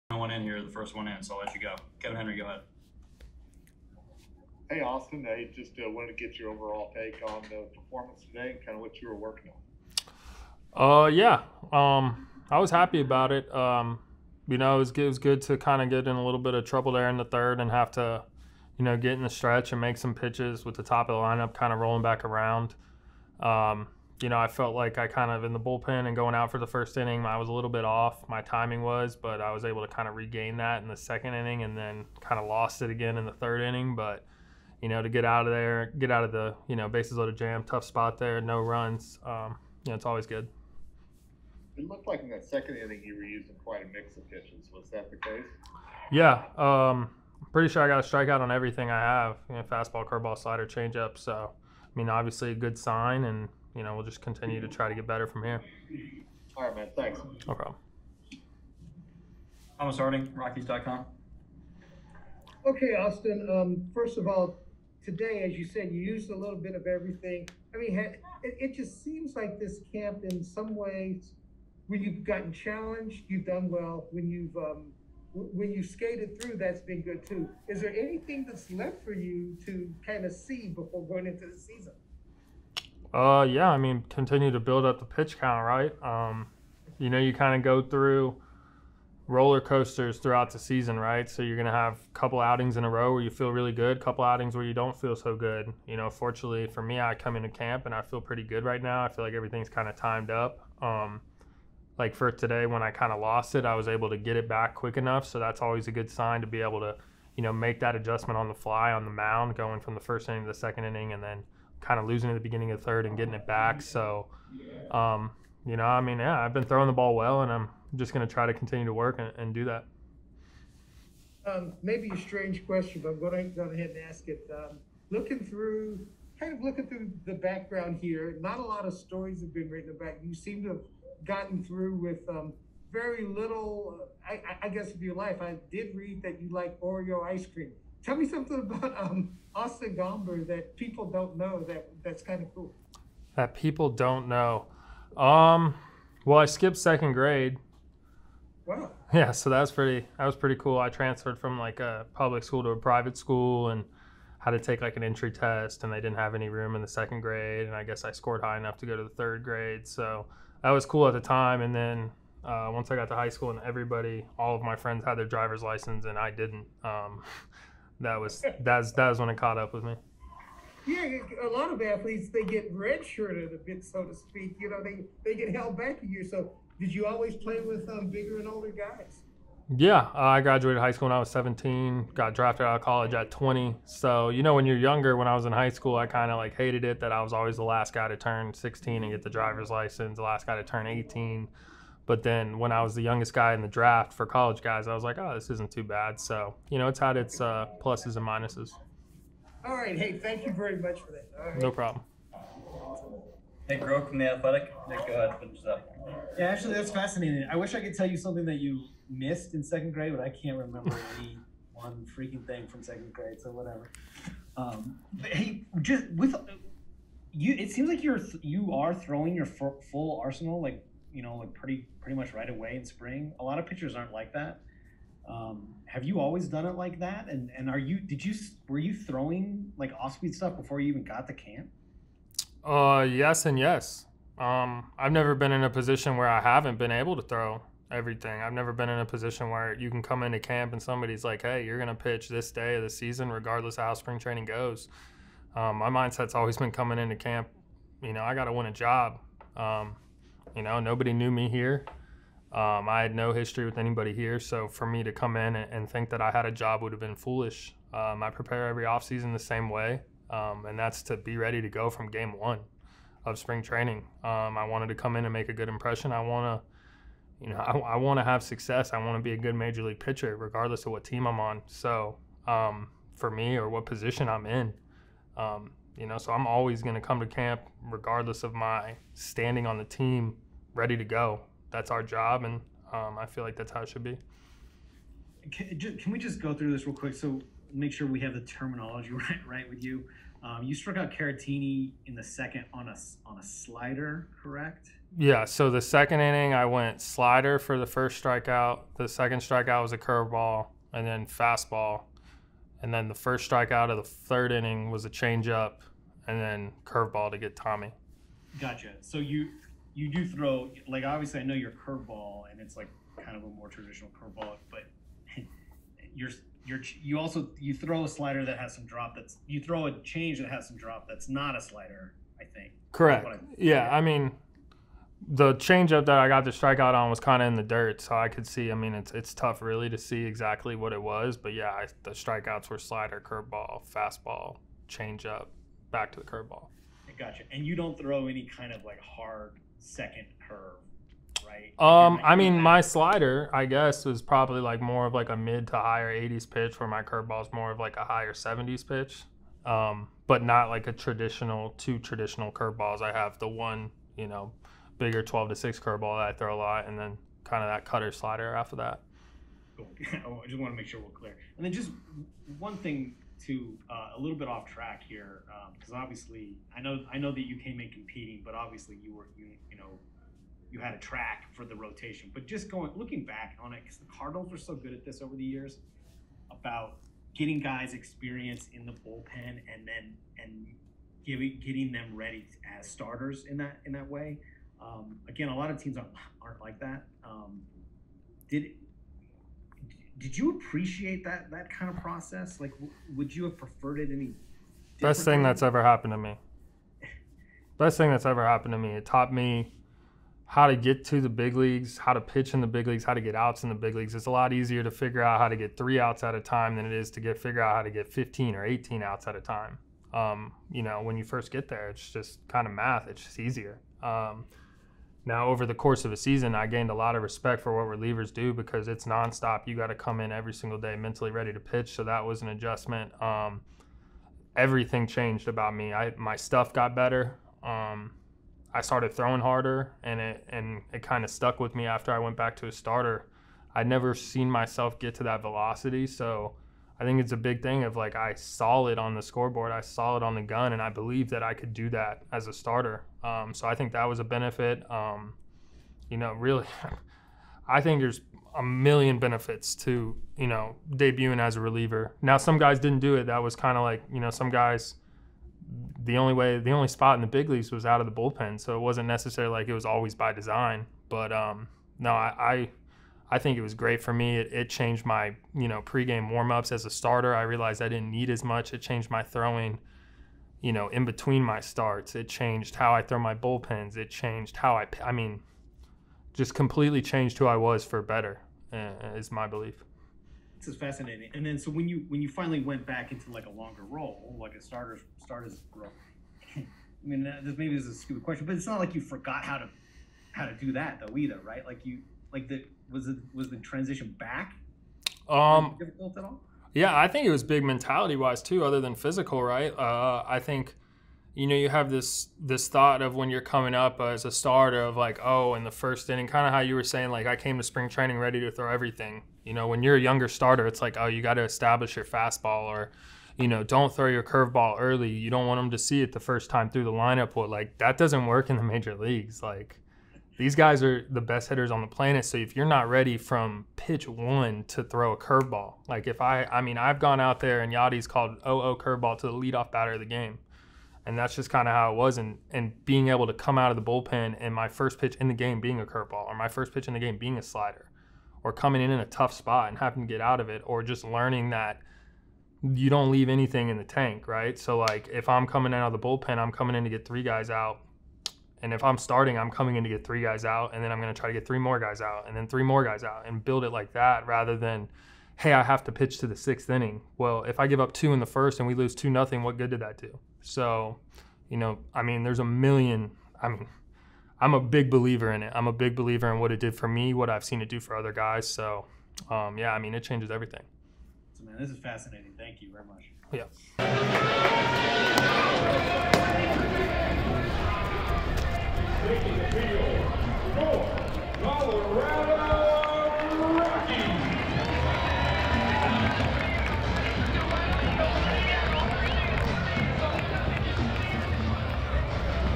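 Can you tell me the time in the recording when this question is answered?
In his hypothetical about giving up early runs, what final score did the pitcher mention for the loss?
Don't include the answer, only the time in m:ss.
9:18.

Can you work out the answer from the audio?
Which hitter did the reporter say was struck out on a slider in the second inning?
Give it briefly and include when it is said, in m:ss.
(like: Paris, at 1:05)
Caratini, at 4:51.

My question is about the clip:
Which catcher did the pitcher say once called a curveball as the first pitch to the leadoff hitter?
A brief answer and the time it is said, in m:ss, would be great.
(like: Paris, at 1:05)
Yadi, at 8:47.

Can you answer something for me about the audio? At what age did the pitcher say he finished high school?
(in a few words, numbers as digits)
17.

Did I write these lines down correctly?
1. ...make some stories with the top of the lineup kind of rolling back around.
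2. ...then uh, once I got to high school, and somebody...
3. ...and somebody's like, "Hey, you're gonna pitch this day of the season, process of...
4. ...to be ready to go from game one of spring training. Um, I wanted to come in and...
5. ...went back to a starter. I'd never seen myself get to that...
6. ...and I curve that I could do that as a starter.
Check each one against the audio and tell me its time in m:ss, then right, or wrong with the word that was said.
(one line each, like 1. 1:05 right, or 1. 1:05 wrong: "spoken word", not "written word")
1. 0:19 wrong: "pitches", not "stories"
2. 2:41 wrong: "everybody", not "somebody"
3. 4:00 wrong: "regardless", not "process"
4. 4:21 right
5. 7:12 right
6. 7:20 wrong: "believe", not "curve".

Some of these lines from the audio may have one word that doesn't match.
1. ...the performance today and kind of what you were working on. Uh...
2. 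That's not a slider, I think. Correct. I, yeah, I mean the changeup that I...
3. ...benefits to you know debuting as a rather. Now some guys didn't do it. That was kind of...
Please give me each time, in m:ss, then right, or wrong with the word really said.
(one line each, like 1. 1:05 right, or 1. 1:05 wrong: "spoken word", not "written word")
1. 0:07 right
2. 5:21 right
3. 7:29 wrong: "reliever", not "rather".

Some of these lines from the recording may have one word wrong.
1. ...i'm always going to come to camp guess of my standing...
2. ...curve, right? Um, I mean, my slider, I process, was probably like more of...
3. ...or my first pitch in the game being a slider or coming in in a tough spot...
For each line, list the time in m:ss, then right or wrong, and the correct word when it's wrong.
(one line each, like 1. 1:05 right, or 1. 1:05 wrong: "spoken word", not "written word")
1. 4:36 wrong: "regardless", not "guess"
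2. 5:40 wrong: "guess", not "process"
3. 8:56 right.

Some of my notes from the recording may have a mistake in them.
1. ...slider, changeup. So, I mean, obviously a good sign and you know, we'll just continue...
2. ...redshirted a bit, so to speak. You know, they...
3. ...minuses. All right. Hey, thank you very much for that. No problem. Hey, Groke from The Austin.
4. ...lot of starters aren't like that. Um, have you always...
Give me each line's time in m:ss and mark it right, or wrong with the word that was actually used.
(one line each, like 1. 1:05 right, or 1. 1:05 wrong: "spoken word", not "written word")
1. 0:50 right
2. 2:52 right
3. 3:18 wrong: "Athletic", not "Austin"
4. 3:43 wrong: "pitchers", not "starters".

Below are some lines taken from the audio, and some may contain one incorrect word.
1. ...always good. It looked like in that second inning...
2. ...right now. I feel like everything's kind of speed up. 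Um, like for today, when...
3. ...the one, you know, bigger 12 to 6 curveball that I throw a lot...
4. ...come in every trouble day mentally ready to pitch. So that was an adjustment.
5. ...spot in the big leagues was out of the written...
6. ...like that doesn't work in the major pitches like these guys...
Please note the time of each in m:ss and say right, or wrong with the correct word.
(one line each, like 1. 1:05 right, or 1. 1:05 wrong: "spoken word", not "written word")
1. 0:40 right
2. 1:38 wrong: "timed", not "speed"
3. 5:53 right
4. 6:59 wrong: "single", not "trouble"
5. 7:36 wrong: "bullpen", not "written"
6. 8:37 wrong: "leagues", not "pitches".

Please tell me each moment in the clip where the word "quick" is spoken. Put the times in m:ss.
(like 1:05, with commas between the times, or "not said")
1:44, 4:46.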